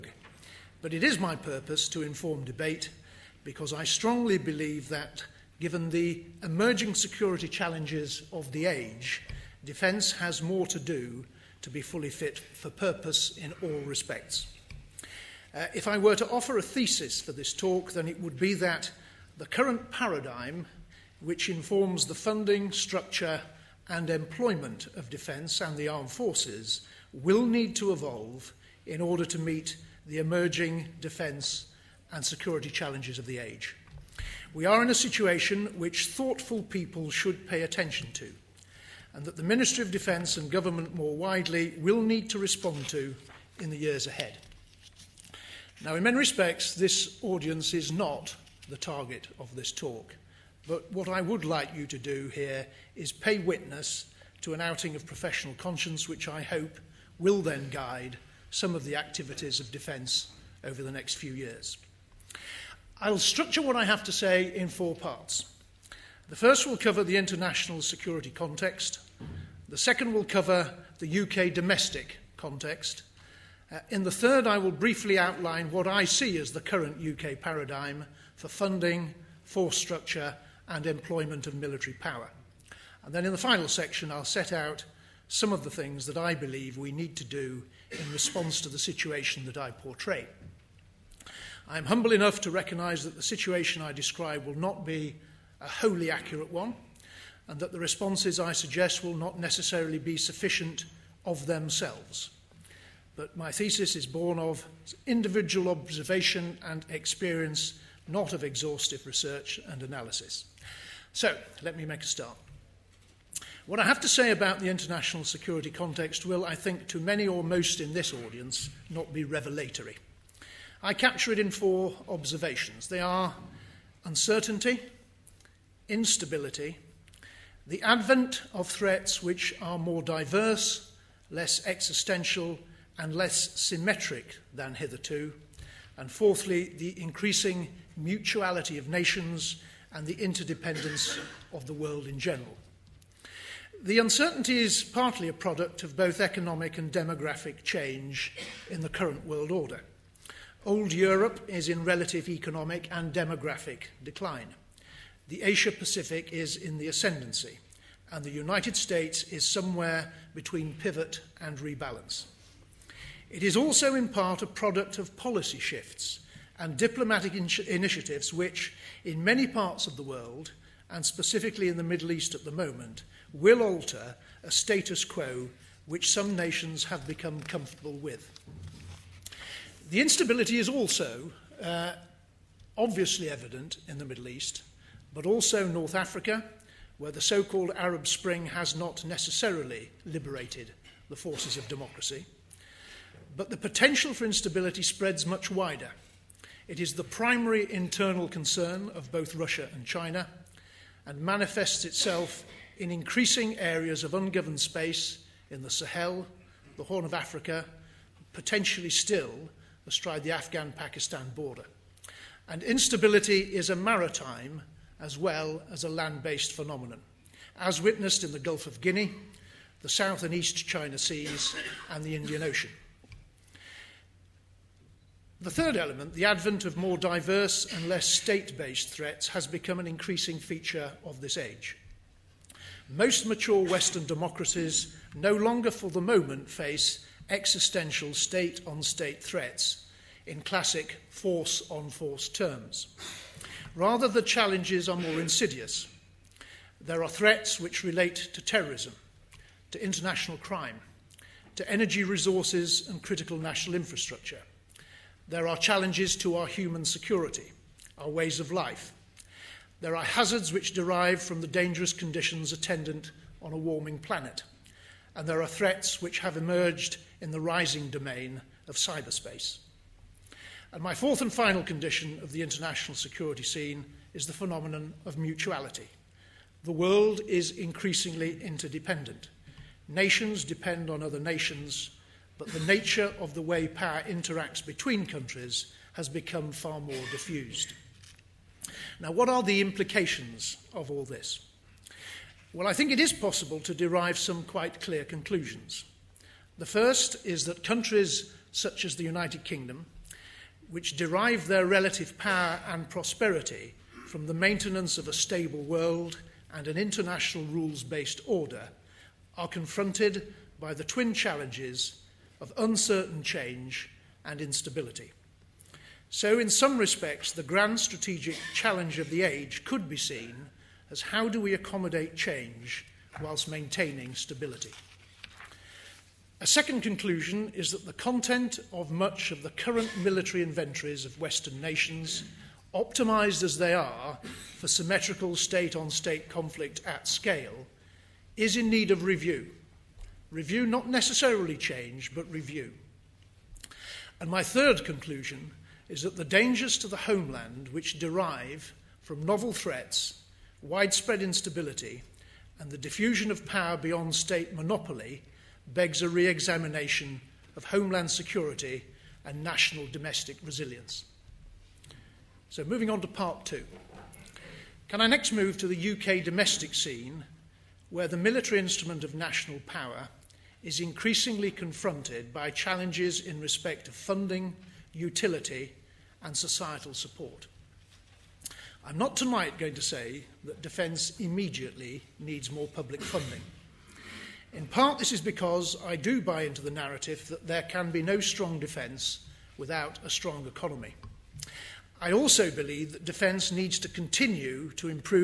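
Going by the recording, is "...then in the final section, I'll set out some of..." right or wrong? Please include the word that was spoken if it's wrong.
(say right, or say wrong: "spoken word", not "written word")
right.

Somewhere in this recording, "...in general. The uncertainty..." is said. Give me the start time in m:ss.
2:22.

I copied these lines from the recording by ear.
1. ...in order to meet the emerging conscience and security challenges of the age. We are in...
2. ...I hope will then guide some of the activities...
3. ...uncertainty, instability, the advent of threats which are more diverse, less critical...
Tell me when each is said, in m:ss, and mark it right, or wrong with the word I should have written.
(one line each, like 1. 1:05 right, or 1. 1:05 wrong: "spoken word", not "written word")
1. 0:28 wrong: "defence", not "conscience"
2. 0:56 right
3. 2:04 wrong: "existential", not "critical".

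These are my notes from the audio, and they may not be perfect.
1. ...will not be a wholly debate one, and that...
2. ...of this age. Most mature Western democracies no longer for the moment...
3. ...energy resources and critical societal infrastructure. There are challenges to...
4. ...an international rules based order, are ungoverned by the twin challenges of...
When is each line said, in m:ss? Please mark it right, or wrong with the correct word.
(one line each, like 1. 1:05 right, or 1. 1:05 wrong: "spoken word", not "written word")
1. 1:34 wrong: "accurate", not "debate"
2. 3:51 right
3. 4:11 wrong: "national", not "societal"
4. 5:06 wrong: "confronted", not "ungoverned".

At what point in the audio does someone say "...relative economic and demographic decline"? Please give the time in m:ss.
2:31.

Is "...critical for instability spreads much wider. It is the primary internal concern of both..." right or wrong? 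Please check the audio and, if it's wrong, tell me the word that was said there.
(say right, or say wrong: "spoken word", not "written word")
wrong: "potential", not "critical".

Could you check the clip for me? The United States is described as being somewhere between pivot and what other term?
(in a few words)
rebalance.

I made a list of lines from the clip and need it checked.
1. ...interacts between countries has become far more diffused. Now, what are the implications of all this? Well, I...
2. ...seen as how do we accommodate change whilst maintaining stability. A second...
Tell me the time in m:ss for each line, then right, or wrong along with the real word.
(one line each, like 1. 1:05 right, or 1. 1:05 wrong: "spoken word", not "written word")
1. 4:44 right
2. 5:19 right.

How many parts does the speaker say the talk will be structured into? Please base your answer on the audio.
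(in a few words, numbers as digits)
4.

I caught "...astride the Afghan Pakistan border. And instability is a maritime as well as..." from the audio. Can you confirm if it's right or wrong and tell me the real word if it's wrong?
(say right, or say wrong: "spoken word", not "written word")
right.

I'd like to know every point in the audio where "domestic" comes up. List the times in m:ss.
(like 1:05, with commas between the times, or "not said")
1:11, 5:59, 6:06.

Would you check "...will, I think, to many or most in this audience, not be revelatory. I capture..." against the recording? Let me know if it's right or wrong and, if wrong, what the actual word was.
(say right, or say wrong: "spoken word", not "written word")
right.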